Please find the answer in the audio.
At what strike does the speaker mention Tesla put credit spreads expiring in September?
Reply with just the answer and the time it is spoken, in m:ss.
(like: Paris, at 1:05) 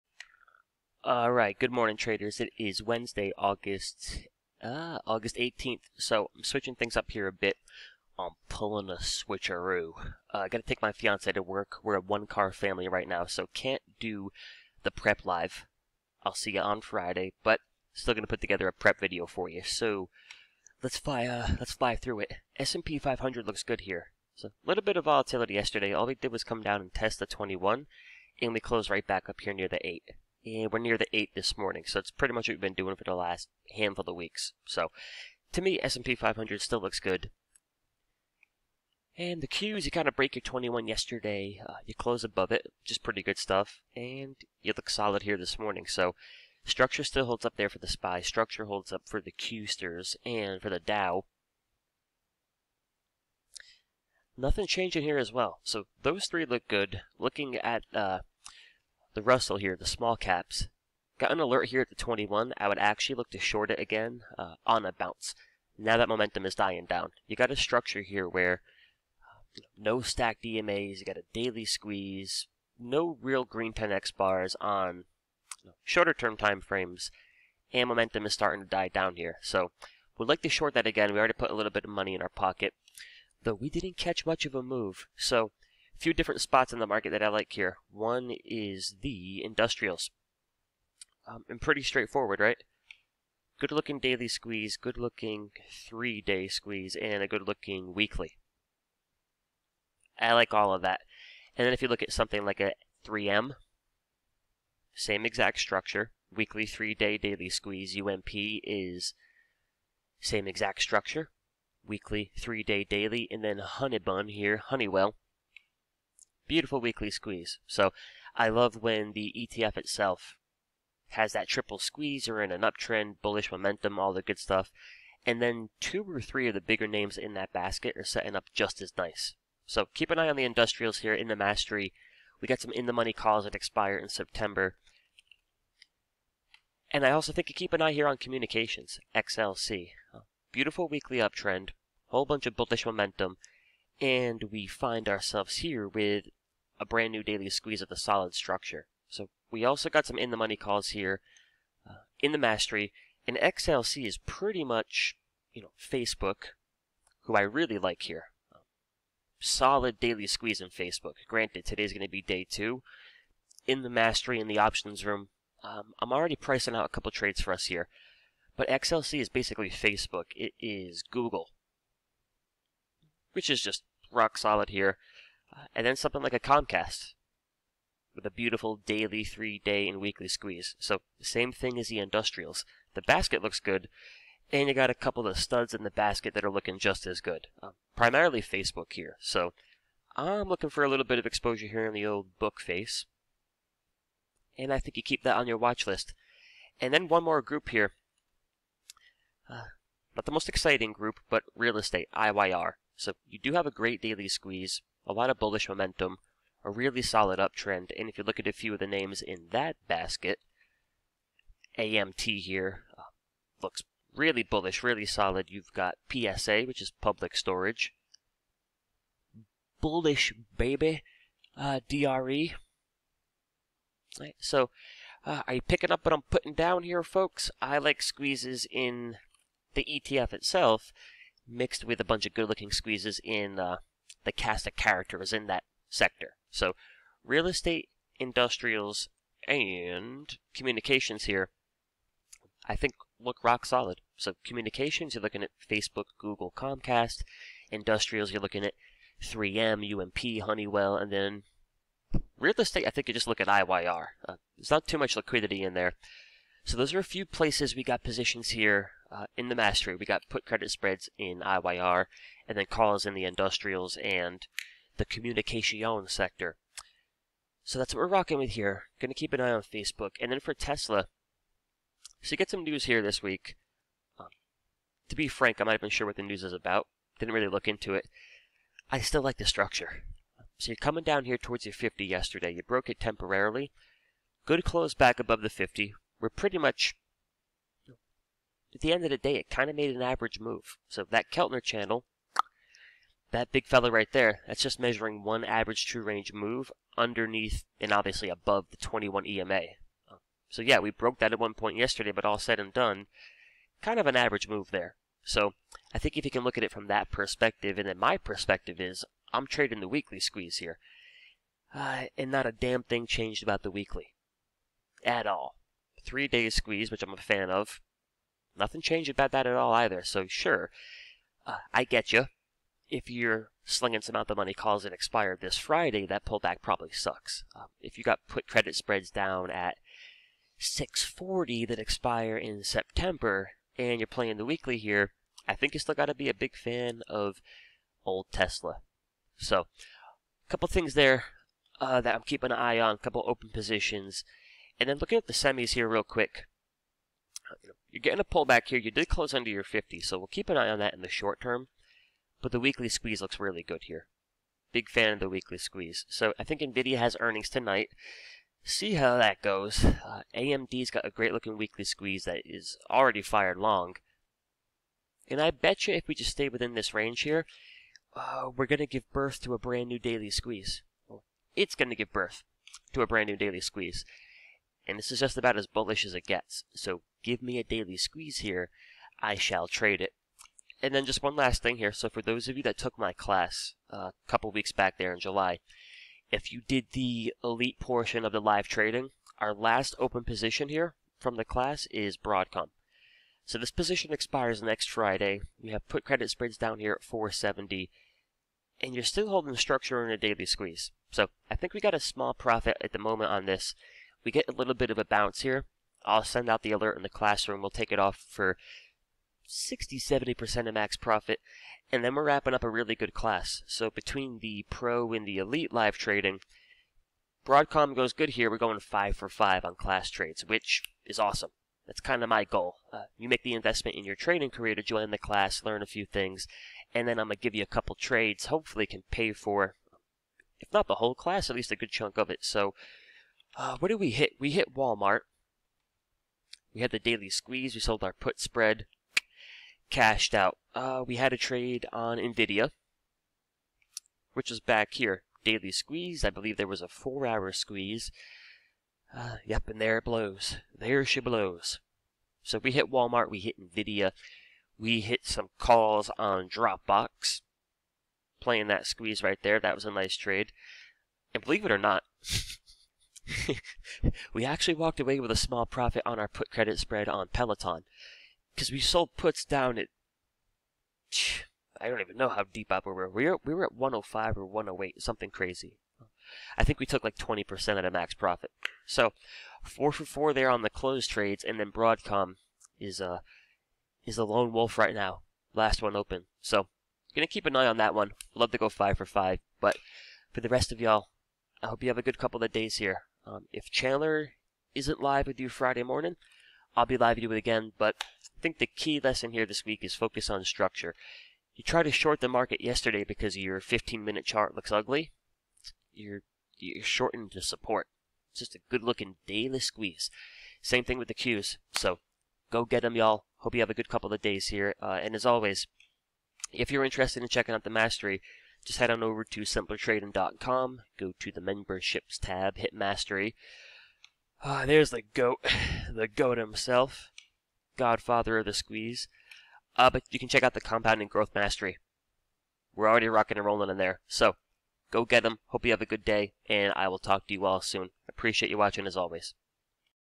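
640, at 5:30.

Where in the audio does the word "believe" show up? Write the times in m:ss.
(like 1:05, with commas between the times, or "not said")
7:26, 7:41.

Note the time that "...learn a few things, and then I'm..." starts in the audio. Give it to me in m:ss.
7:05.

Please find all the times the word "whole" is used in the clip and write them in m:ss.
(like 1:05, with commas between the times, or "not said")
2:22, 7:10.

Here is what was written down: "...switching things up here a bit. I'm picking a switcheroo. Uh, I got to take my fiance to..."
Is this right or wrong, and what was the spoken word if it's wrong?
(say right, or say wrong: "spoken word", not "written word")
wrong: "pulling", not "picking".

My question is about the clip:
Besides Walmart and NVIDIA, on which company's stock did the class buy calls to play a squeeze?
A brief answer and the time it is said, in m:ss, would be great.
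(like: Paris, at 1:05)
Dropbox, at 7:36.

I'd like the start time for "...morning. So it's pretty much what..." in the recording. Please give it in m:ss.
0:31.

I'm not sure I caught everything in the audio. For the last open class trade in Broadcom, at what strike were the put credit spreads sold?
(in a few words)
470.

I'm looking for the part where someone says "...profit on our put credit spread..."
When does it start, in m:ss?
7:45.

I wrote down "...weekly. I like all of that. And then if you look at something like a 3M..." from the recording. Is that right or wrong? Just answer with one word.
right.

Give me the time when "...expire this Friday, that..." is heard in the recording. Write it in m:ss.
5:24.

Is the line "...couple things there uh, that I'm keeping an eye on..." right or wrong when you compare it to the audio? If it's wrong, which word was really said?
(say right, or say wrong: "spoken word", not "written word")
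right.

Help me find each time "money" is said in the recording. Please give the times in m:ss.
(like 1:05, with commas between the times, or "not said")
1:21, 2:12, 2:30, 5:24.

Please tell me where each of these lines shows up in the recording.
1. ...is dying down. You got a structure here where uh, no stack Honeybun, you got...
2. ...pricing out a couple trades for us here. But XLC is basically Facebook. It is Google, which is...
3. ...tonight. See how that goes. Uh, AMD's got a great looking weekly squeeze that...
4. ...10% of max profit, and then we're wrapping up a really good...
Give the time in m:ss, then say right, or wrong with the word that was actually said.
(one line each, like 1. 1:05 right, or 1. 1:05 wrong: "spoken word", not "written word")
1. 1:06 wrong: "DMAs", not "Honeybun"
2. 2:46 right
3. 5:57 right
4. 6:49 wrong: "70", not "10".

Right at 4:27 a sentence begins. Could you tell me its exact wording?
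So that's what we're rocking with here.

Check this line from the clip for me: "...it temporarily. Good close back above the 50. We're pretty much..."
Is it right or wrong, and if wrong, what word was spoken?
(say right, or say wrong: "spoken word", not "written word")
right.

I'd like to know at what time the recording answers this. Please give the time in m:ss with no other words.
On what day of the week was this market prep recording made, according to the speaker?
0:02.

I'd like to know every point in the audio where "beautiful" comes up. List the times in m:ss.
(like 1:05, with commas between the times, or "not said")
1:56, 2:20, 2:58.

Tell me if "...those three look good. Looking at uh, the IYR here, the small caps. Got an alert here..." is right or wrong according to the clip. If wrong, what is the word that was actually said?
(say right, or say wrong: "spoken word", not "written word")
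wrong: "Russell", not "IYR".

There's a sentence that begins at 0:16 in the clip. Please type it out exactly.
I'll see you on Friday, but still gonna put together a prep video for you.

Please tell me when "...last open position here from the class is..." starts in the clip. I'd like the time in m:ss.
6:29.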